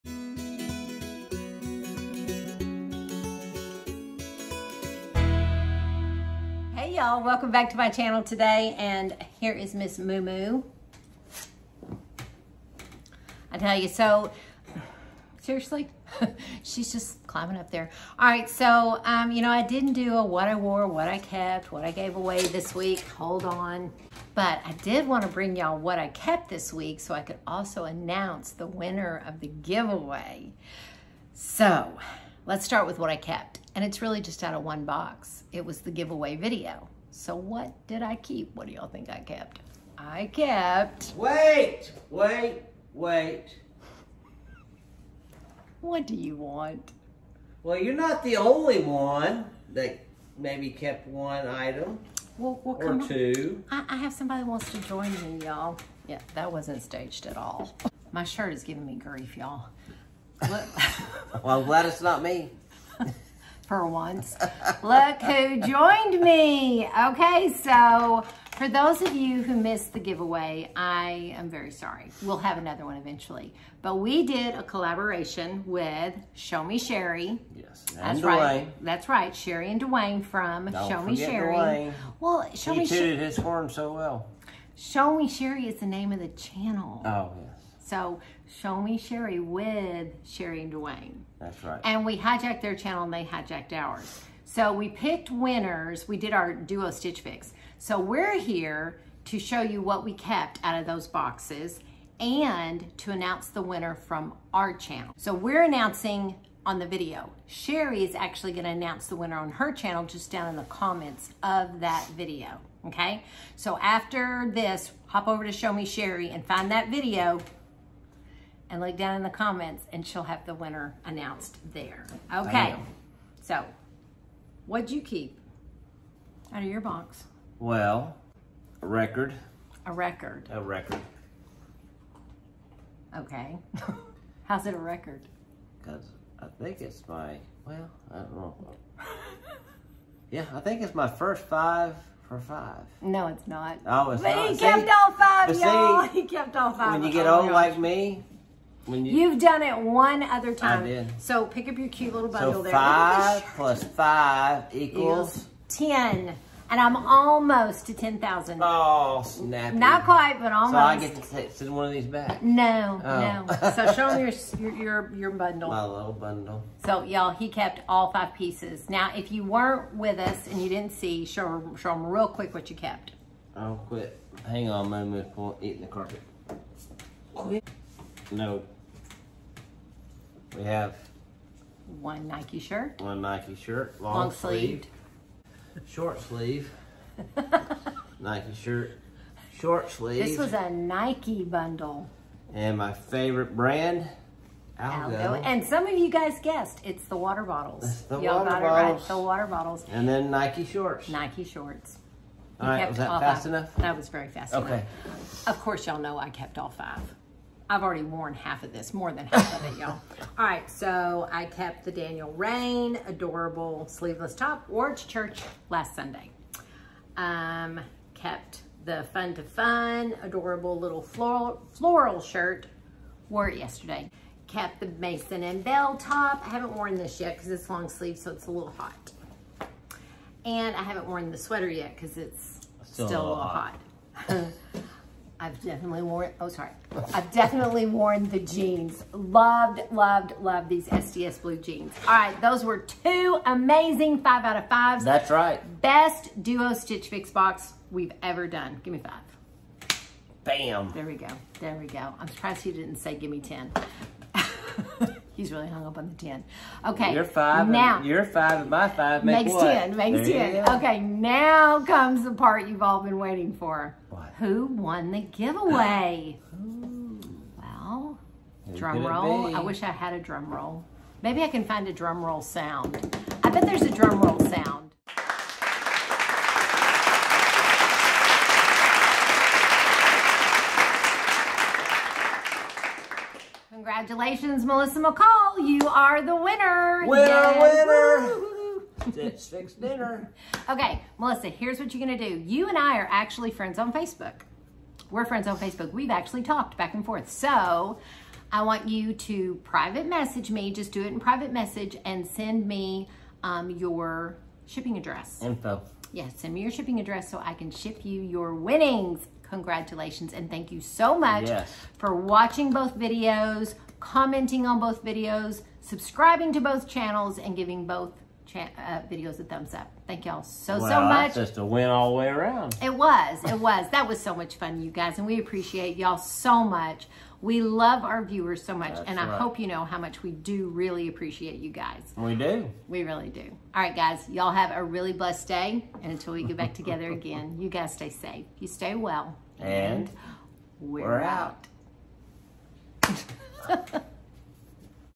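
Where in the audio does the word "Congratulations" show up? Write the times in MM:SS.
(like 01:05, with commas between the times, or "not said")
04:43, 05:09.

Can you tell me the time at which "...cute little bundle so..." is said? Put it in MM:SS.
02:31.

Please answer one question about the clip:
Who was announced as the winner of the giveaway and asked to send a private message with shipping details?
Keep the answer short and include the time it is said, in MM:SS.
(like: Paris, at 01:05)
Melissa McCall, at 04:44.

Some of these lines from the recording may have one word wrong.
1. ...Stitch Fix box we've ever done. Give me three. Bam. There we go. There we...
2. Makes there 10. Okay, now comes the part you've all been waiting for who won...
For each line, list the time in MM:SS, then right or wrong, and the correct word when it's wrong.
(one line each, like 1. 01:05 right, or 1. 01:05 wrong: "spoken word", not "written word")
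1. 04:06 wrong: "five", not "three"
2. 04:19 right.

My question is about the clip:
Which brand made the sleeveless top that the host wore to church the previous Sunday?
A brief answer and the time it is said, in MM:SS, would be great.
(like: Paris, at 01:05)
Daniel Rainn, at 03:31.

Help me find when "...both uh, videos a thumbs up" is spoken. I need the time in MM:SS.
05:17.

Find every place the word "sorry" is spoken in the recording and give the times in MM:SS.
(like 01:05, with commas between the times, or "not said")
01:11, 03:56.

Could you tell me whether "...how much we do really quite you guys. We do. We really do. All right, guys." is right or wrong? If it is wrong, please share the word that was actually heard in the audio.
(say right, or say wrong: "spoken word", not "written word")
wrong: "appreciate", not "quite".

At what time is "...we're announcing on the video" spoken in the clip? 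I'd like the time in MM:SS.
01:45.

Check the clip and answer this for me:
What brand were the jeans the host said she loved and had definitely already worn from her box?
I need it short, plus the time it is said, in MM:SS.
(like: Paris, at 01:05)
STS Blue, at 04:00.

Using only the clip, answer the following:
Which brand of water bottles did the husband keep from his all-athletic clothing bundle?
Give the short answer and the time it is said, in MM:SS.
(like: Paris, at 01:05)
Algo, at 03:12.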